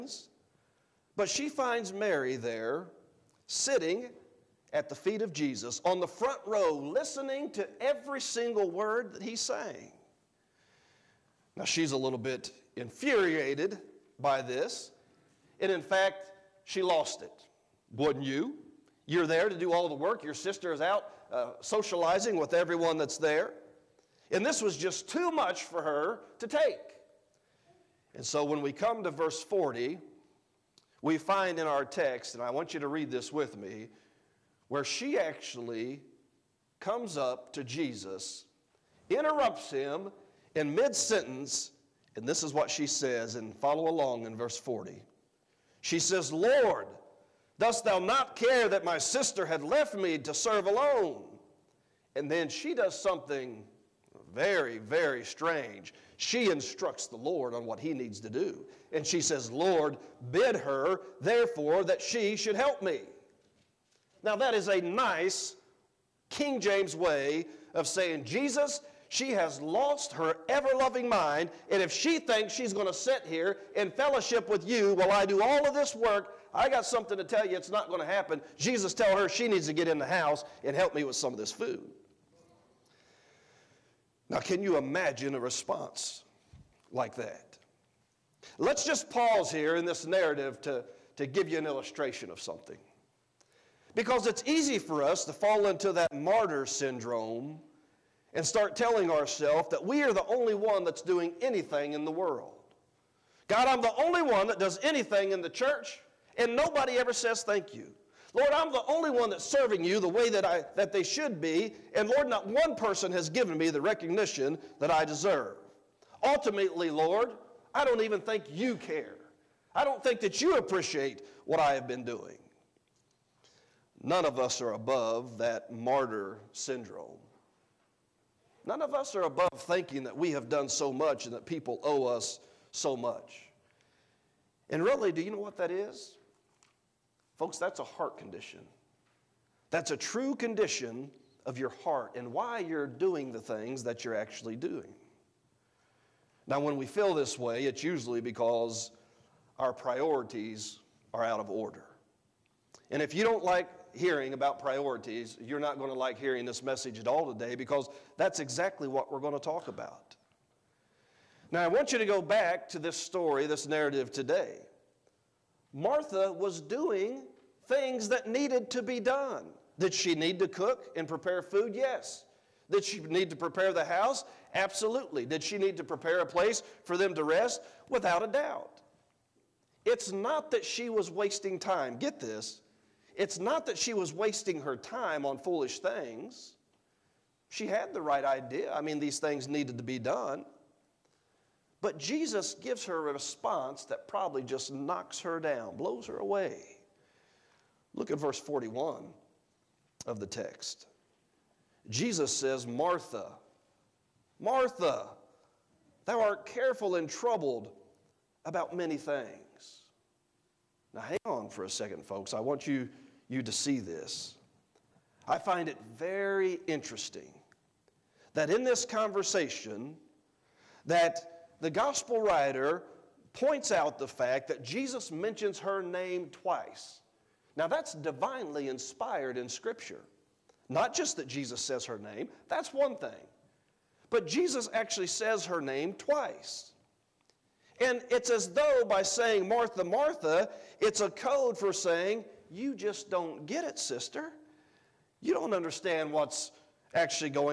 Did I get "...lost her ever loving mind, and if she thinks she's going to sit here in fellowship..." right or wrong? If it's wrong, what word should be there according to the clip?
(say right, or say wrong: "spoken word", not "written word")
right.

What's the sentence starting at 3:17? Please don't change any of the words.
Look at verse 41 of the text.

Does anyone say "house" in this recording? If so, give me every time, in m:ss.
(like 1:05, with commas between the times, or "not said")
1:20, 2:53.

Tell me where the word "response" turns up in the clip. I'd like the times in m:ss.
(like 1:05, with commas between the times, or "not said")
1:25, 3:13.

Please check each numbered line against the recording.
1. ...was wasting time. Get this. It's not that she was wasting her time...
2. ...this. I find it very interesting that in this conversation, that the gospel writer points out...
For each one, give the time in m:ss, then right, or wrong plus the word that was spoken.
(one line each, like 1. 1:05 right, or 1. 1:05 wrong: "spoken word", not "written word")
1. 3:00 right
2. 3:33 right.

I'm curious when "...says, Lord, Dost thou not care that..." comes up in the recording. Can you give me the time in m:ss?
0:45.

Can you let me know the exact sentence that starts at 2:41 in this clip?
Now, I want you to go back to this story, this narrative today.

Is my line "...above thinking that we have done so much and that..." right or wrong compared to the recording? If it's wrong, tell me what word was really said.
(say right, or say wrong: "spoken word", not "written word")
right.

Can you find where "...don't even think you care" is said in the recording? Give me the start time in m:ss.
1:57.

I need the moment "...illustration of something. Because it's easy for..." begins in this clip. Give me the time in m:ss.
1:31.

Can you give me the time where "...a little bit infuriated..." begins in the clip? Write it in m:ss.
0:11.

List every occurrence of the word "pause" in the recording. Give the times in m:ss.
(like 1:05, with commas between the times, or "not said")
1:29.